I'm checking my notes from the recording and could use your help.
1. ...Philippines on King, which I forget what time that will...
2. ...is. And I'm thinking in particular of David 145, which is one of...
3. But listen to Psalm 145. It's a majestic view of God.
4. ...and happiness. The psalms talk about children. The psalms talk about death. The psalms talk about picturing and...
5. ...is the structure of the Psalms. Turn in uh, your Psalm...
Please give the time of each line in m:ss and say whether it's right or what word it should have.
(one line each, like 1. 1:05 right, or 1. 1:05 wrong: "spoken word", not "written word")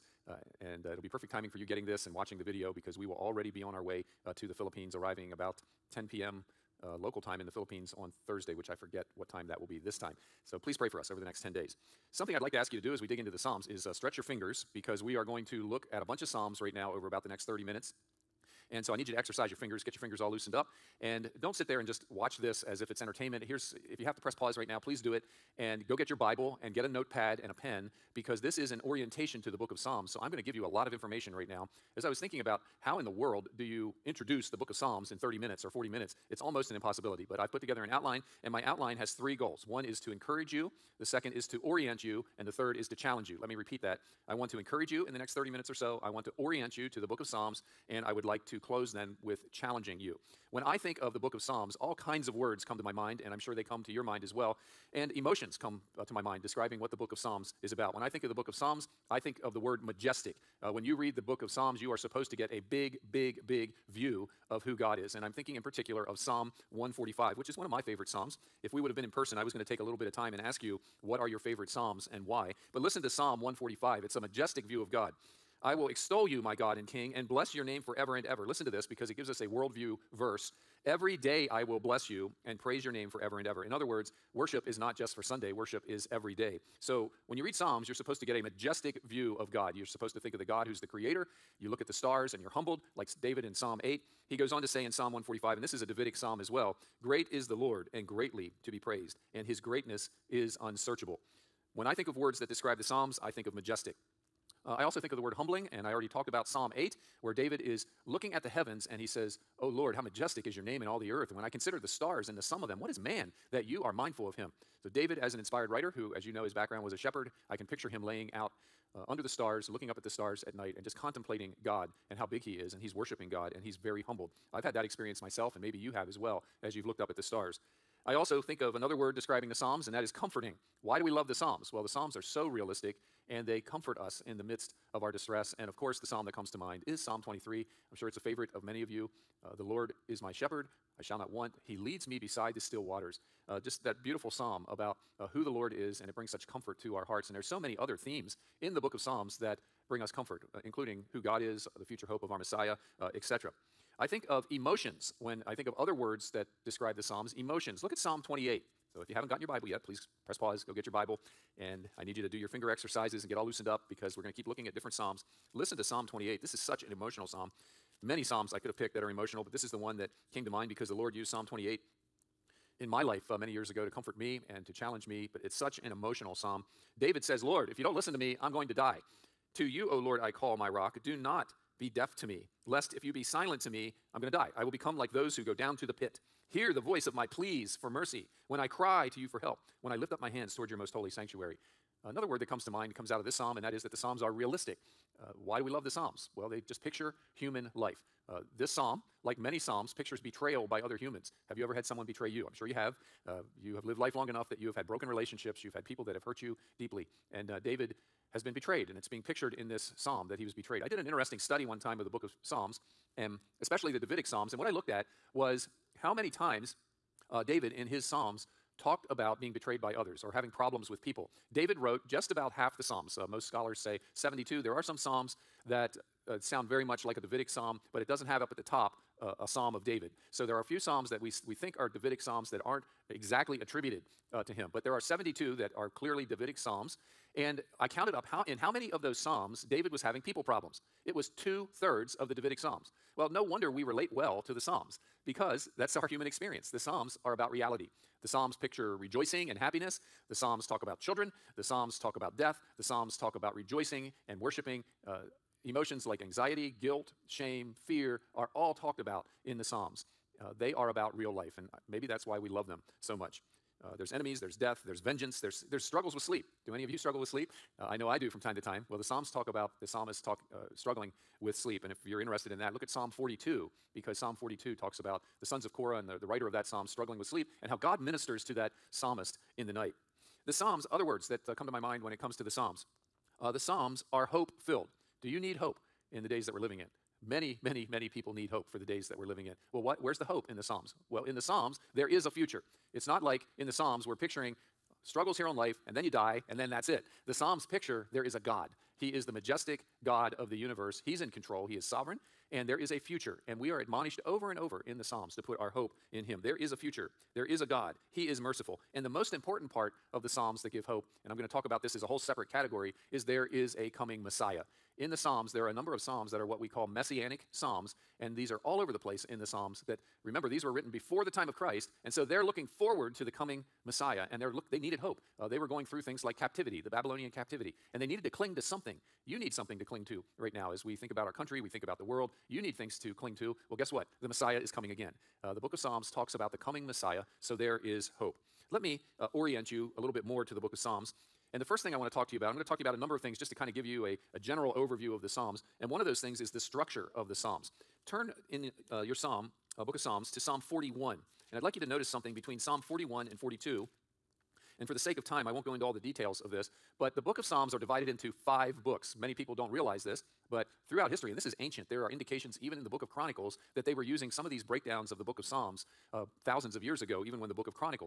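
1. 0:07 wrong: "Thursday", not "King"
2. 1:04 wrong: "Psalm", not "David"
3. 1:12 right
4. 4:09 wrong: "rejoicing", not "picturing"
5. 5:46 right.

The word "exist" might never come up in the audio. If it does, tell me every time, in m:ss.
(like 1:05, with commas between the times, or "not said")
not said.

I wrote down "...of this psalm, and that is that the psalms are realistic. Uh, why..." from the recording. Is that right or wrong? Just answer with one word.
right.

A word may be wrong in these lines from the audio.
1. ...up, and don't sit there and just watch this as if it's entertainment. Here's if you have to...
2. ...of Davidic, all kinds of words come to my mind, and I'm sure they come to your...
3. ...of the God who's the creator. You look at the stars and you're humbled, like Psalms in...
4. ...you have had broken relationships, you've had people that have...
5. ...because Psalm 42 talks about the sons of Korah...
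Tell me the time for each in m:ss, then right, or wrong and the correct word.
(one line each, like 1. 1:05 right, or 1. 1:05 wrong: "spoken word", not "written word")
1. 0:20 right
2. 0:51 wrong: "Psalms", not "Davidic"
3. 1:30 wrong: "David", not "Psalms"
4. 3:24 right
5. 4:33 right.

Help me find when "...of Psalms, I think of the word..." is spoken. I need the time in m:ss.
0:58.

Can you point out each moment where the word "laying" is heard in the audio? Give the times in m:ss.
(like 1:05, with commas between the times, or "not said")
1:58.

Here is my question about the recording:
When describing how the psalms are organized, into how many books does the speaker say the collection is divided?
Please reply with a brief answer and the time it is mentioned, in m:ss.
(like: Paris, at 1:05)
5, at 5:58.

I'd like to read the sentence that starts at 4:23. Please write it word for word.
Uh, there's enemies, there's death, there's vengeance, there's, there's struggles with sleep.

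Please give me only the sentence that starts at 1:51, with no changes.
And when I consider the stars and the sum of them, what is man that you are mindful of him?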